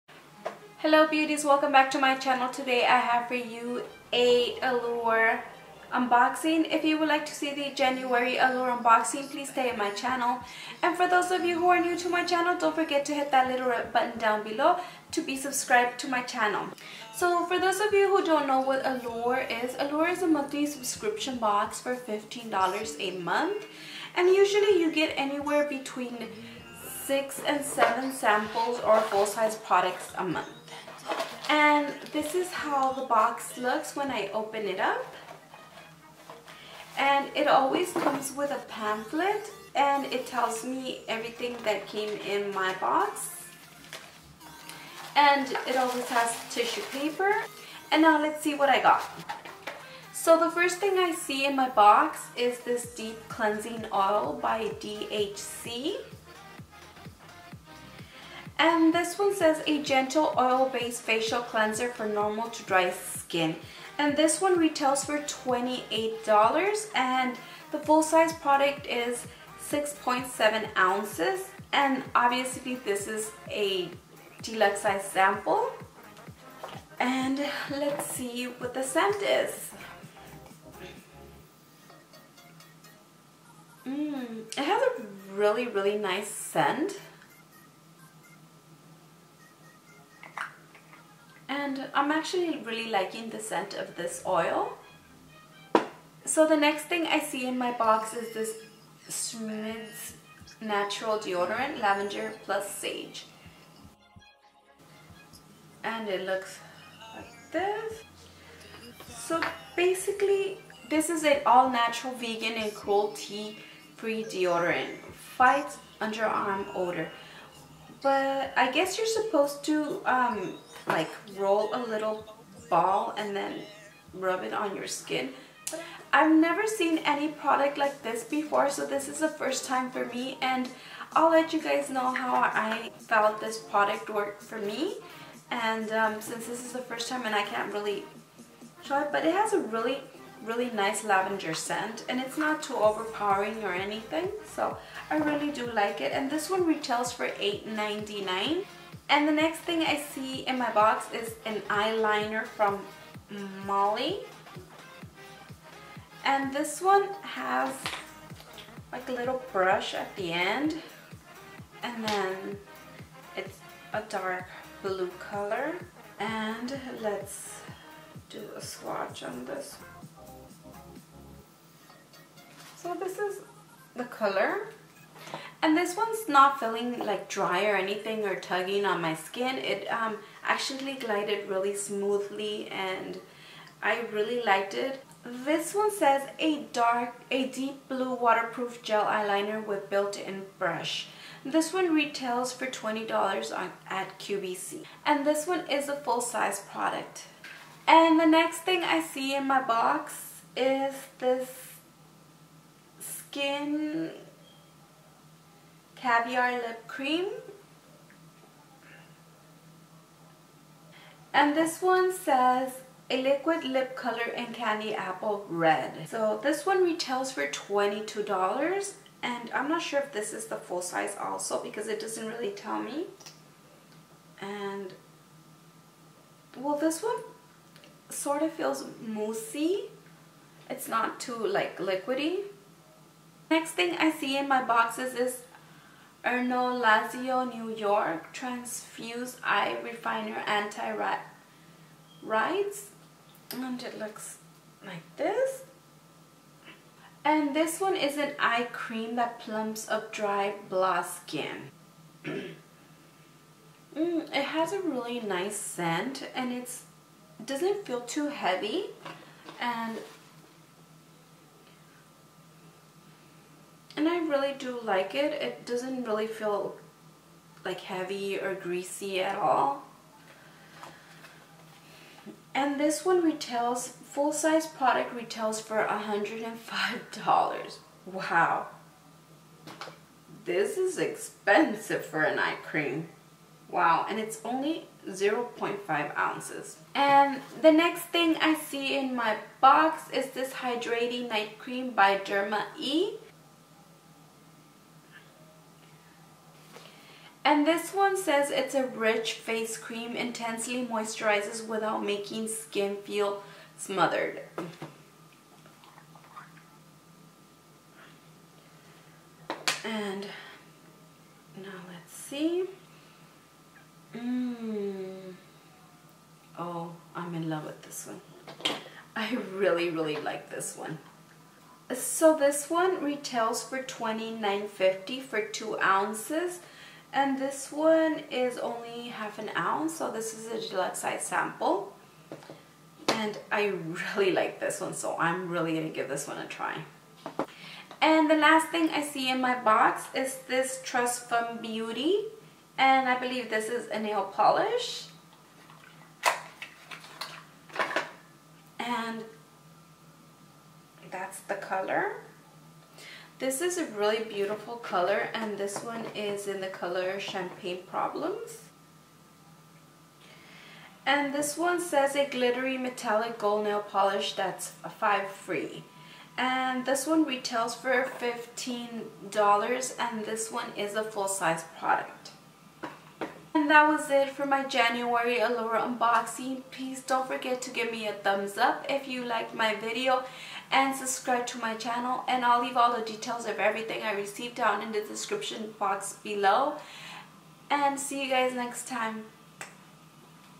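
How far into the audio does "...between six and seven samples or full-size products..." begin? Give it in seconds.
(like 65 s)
25 s.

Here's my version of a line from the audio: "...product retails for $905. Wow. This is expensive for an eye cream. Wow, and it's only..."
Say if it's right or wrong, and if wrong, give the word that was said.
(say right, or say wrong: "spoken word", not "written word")
wrong: "105", not "905".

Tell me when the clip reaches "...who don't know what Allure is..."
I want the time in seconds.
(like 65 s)
18 s.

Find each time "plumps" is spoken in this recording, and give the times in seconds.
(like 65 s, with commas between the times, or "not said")
249 s.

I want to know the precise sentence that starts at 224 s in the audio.
And well this one sort of feels moussey.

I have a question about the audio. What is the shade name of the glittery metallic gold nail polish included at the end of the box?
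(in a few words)
Champagne Problems.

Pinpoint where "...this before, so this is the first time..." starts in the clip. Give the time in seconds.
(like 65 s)
128 s.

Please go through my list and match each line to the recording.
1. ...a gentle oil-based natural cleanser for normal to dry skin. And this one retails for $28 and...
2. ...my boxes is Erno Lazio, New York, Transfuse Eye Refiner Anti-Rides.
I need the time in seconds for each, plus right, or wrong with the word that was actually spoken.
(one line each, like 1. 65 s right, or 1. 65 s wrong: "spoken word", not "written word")
1. 59 s wrong: "facial", not "natural"
2. 234 s right.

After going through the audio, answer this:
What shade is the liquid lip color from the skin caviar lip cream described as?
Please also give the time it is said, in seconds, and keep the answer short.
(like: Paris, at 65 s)
candy apple red, at 214 s.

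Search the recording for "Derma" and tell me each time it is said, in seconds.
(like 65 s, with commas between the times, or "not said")
292 s.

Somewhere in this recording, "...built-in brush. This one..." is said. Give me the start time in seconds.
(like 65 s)
189 s.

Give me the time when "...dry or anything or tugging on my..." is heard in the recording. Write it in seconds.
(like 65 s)
177 s.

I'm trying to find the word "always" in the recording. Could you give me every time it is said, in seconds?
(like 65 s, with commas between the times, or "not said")
37 s, 45 s.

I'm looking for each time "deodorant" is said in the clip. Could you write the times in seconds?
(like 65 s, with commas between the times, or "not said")
101 s, 114 s.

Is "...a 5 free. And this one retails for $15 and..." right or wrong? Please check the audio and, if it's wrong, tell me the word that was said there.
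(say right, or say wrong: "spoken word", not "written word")
right.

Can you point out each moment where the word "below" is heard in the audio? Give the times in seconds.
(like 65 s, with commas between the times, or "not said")
14 s, 386 s.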